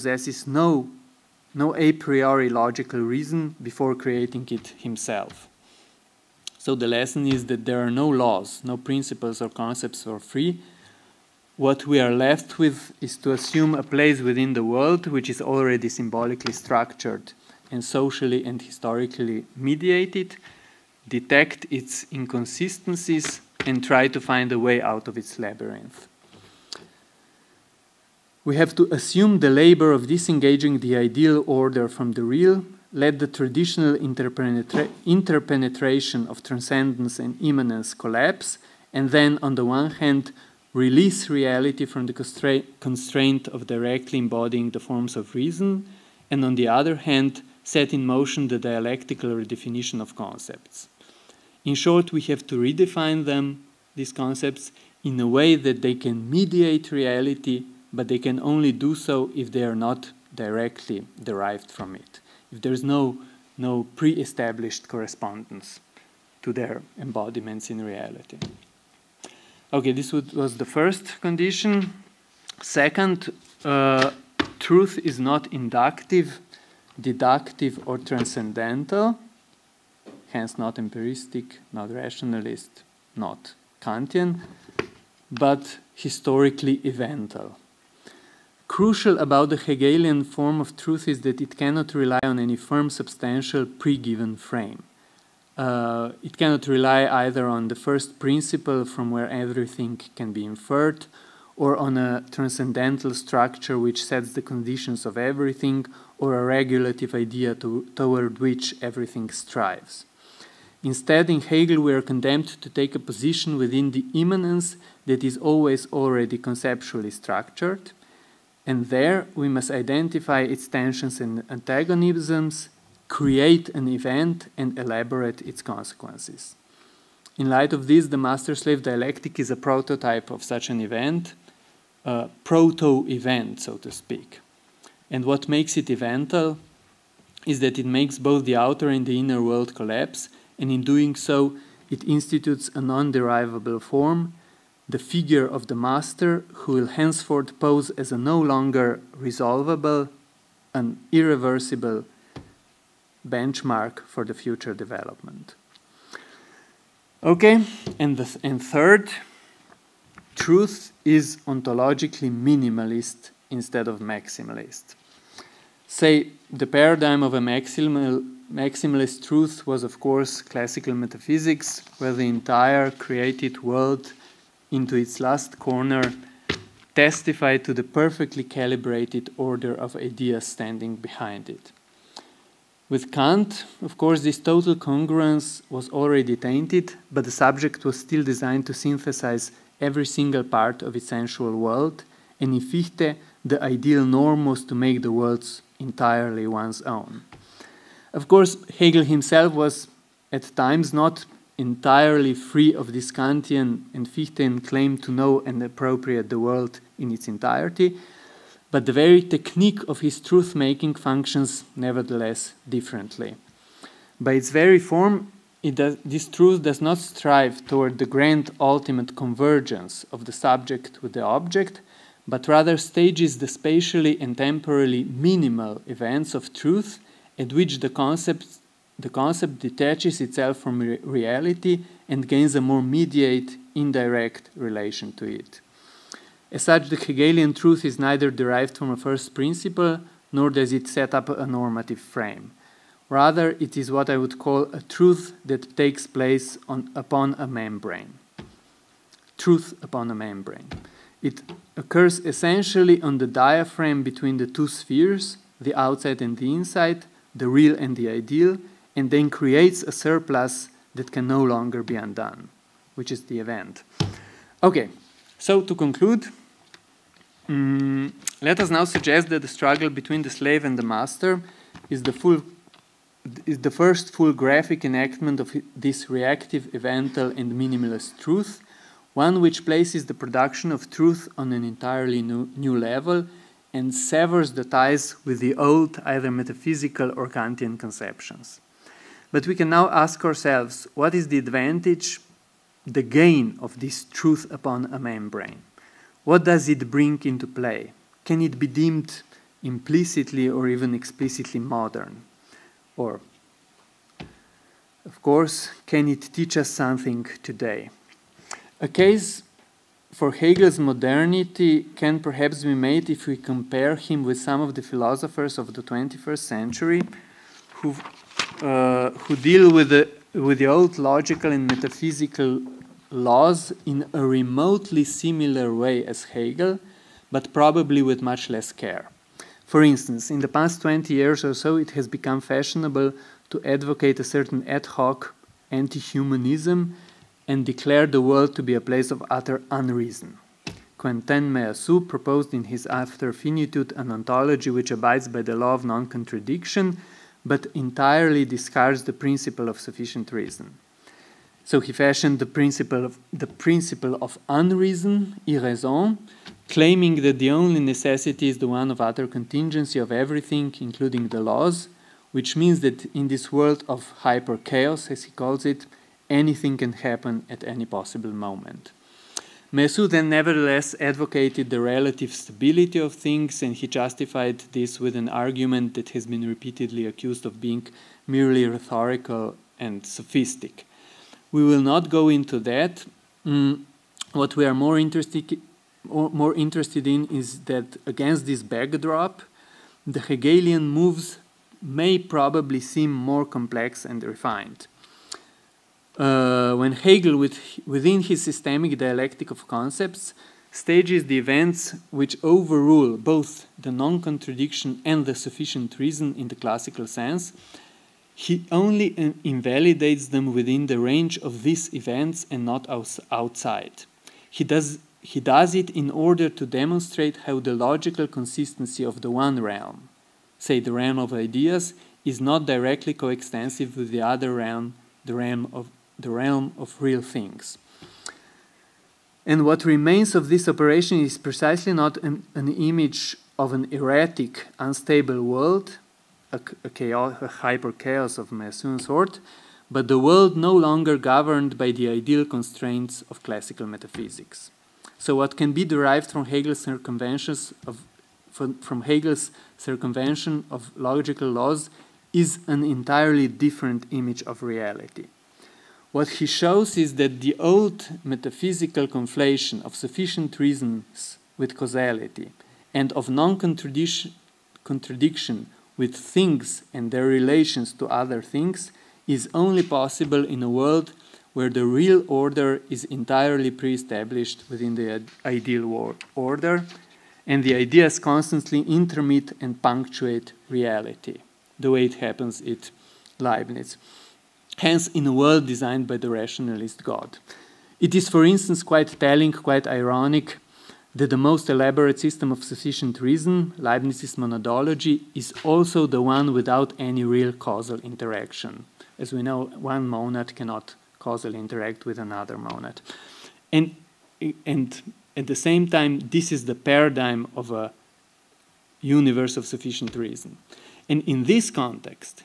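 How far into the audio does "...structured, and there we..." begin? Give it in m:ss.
1:57.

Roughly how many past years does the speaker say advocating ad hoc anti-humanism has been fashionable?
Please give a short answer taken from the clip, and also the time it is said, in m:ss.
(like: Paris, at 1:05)
20, at 5:30.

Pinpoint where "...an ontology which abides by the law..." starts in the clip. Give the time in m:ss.
5:43.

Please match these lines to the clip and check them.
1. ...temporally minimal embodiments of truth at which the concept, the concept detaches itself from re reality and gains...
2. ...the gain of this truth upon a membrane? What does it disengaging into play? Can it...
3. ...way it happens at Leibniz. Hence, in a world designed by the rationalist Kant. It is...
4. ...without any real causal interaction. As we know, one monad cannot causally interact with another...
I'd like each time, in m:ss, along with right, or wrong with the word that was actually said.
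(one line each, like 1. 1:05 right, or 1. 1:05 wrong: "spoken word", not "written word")
1. 3:44 wrong: "events", not "embodiments"
2. 4:52 wrong: "bring", not "disengaging"
3. 8:01 wrong: "God", not "Kant"
4. 8:16 right.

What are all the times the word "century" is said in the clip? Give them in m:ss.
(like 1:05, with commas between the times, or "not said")
5:16.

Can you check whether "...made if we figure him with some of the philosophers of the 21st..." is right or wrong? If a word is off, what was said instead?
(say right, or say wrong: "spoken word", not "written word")
wrong: "compare", not "figure".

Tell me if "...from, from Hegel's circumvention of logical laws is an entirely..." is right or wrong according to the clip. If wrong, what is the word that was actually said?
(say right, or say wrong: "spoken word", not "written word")
right.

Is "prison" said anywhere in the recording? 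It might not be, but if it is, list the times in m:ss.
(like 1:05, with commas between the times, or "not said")
not said.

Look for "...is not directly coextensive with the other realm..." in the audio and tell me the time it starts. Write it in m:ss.
7:02.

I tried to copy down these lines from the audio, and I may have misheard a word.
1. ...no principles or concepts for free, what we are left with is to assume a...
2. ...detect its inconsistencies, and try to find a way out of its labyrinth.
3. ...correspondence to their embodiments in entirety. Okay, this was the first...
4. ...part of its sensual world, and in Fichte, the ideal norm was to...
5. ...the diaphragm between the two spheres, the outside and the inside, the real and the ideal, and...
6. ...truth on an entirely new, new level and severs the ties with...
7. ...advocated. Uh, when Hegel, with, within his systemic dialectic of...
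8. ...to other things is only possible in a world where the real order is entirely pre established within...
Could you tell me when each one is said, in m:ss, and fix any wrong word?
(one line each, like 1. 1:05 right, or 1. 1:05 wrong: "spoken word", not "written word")
1. 0:08 right
2. 0:21 right
3. 1:04 wrong: "reality", not "entirety"
4. 3:10 right
5. 4:13 right
6. 4:40 right
7. 6:34 wrong: "refined", not "advocated"
8. 7:47 right.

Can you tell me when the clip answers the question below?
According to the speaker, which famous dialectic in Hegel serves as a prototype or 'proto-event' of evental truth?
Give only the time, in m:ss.
2:08.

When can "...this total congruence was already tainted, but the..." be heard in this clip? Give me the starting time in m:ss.
3:04.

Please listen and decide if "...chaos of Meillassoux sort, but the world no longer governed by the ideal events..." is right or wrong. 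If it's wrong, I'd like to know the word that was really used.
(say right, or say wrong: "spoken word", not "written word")
wrong: "constraints", not "events".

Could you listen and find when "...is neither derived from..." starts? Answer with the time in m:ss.
3:57.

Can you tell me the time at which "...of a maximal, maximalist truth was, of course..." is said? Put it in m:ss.
2:47.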